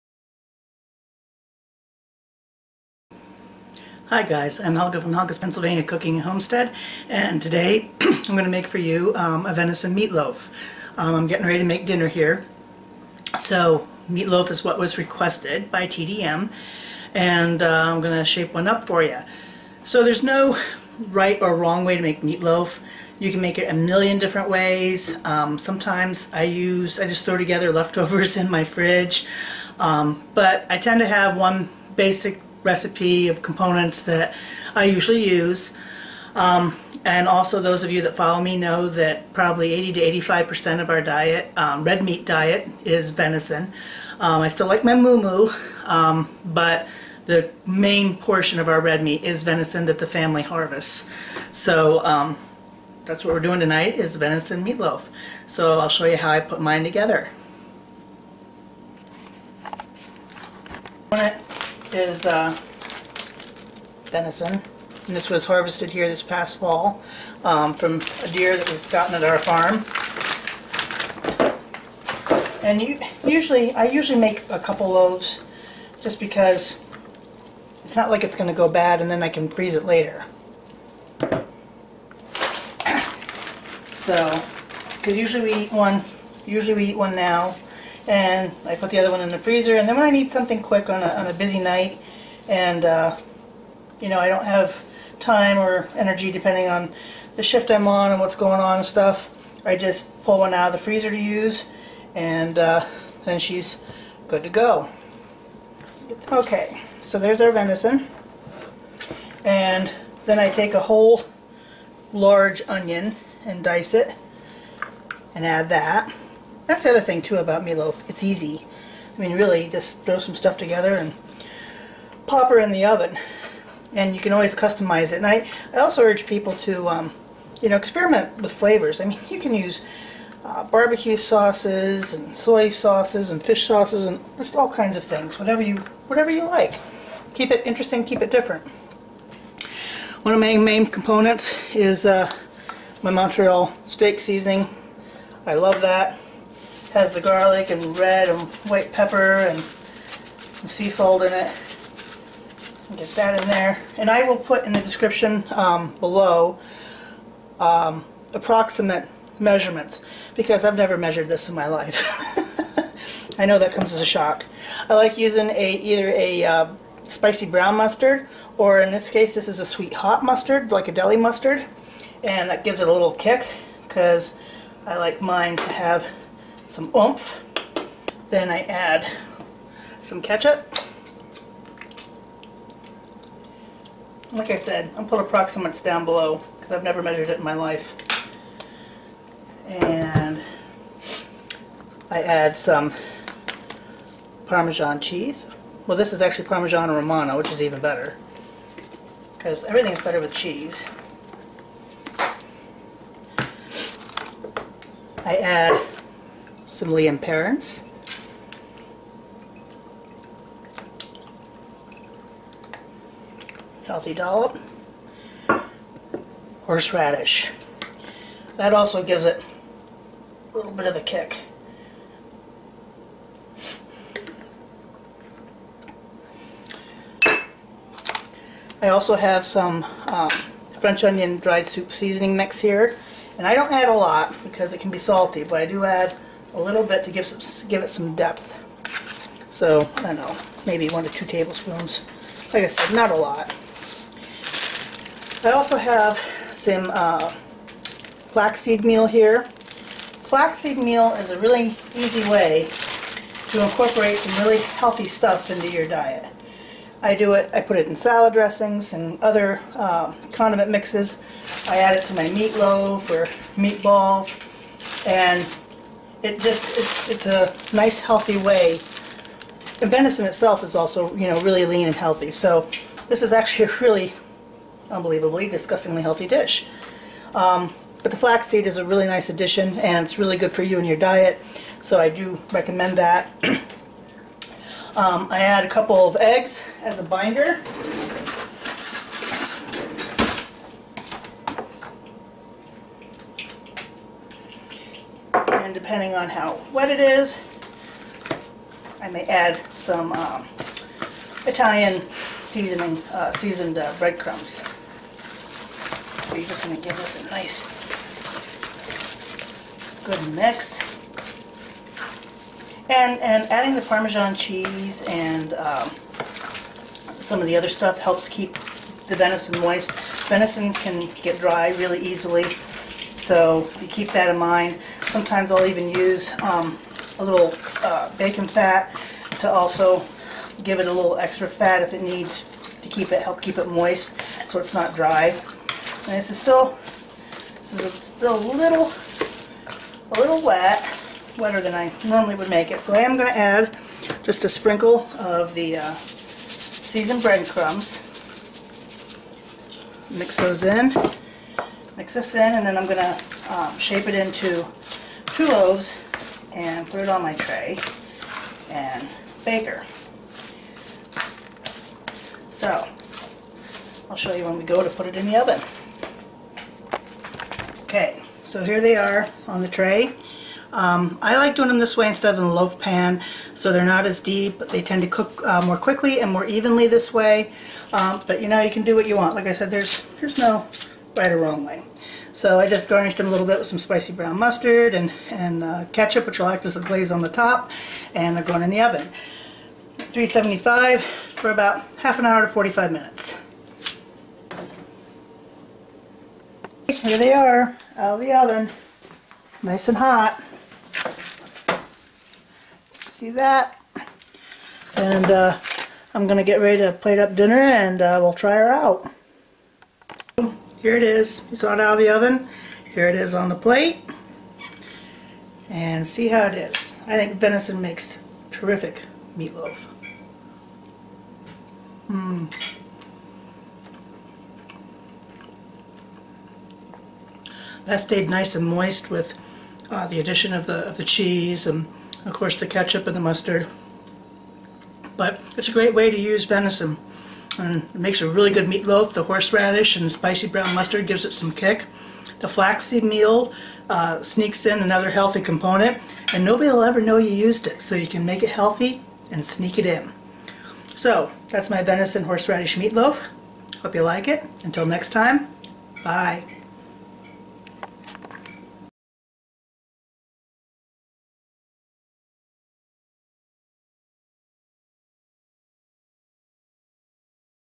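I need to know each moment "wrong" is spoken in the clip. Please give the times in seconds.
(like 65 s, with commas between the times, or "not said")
21 s, 381 s.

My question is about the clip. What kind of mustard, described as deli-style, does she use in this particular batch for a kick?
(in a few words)
Sweet hot mustard.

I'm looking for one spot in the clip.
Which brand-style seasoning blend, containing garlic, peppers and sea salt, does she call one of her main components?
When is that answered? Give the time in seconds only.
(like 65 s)
143 s.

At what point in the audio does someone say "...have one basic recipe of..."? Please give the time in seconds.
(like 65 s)
31 s.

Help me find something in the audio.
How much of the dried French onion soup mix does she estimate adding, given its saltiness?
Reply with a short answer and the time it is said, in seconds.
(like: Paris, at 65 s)
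1 to 2 tablespoons, at 240 s.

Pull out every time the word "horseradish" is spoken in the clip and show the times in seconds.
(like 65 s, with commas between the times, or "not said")
216 s, 439 s, 452 s.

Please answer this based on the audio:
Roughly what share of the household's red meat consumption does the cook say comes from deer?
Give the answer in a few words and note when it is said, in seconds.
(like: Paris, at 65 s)
80 to 85 percent, at 39 s.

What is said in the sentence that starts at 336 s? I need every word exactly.
And this is still, this is still a little, a little wet, wetter than I normally would make it.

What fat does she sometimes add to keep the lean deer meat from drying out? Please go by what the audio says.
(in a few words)
Bacon fat.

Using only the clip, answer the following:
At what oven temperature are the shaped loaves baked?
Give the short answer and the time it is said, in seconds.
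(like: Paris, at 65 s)
375, at 389 s.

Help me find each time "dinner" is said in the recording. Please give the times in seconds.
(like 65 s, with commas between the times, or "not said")
11 s, 407 s.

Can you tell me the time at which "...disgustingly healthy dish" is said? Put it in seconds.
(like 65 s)
275 s.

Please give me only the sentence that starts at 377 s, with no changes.
Um, but you know, you can do what you want.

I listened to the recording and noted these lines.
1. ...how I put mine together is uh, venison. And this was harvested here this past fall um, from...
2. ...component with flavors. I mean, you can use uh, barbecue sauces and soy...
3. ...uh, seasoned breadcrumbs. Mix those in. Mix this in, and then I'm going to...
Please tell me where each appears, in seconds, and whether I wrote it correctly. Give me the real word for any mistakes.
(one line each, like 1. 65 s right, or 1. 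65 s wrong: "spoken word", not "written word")
1. 56 s right
2. 127 s wrong: "experiment", not "component"
3. 345 s right.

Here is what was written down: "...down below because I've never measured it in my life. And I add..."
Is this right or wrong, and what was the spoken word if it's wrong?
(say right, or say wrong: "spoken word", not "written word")
right.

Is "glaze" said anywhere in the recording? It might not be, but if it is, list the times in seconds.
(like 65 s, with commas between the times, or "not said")
386 s.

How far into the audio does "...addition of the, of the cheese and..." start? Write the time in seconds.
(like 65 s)
430 s.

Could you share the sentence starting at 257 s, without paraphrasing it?
I do it, I put it in salad dressings and other uh, condiment mixes.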